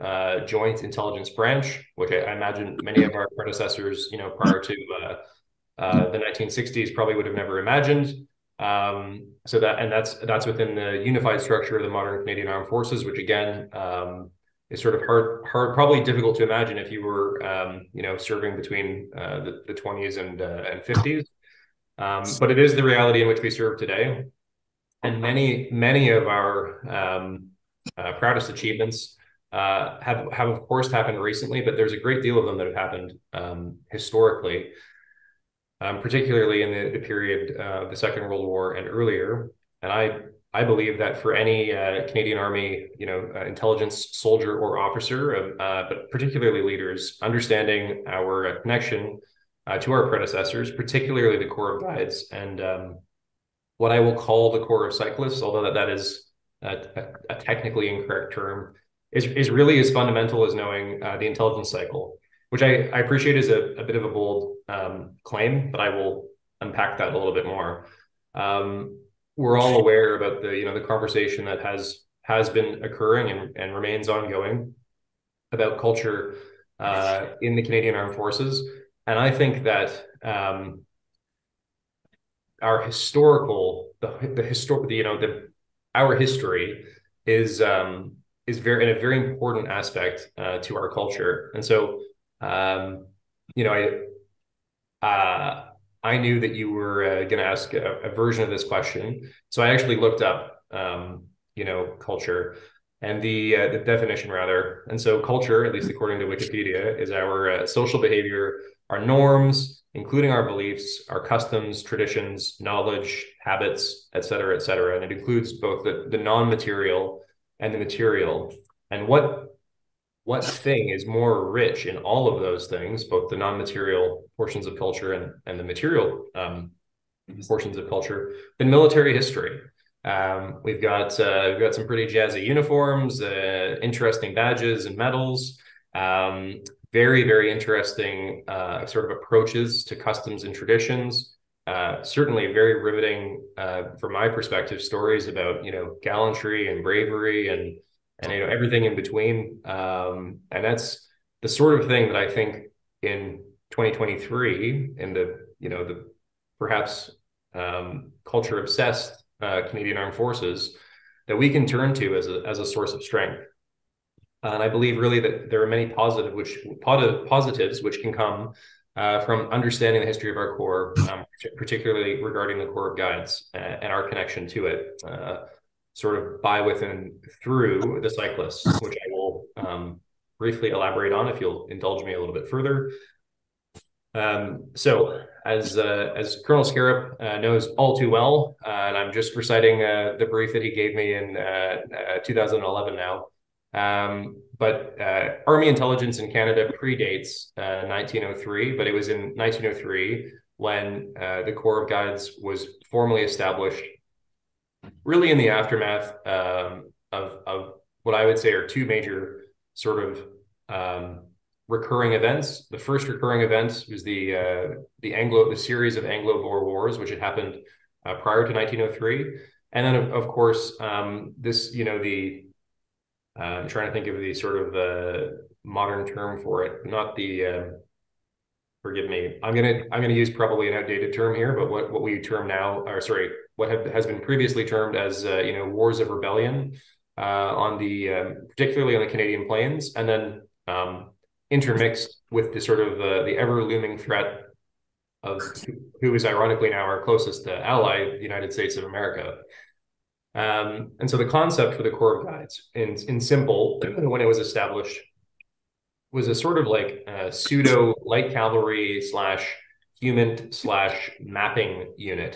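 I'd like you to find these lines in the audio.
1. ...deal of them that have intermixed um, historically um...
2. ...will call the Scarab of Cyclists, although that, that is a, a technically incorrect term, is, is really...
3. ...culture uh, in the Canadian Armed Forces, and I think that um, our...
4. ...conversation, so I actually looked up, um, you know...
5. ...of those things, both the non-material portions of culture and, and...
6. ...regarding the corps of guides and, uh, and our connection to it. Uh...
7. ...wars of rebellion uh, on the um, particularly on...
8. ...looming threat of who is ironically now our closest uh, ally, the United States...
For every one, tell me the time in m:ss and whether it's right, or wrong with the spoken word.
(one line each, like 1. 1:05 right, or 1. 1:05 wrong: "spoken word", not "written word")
1. 0:32 wrong: "happened", not "intermixed"
2. 0:54 wrong: "Corps", not "Scarab"
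3. 1:15 right
4. 1:38 wrong: "question", not "conversation"
5. 2:02 right
6. 2:52 right
7. 3:55 right
8. 4:03 right.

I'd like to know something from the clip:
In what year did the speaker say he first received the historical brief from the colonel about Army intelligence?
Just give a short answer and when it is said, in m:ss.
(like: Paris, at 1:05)
2011, at 3:12.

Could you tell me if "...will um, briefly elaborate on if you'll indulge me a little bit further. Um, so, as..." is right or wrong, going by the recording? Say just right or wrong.
right.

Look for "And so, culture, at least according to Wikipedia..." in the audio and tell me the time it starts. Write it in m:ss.
1:44.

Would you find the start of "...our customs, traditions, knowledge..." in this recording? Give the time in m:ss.
1:51.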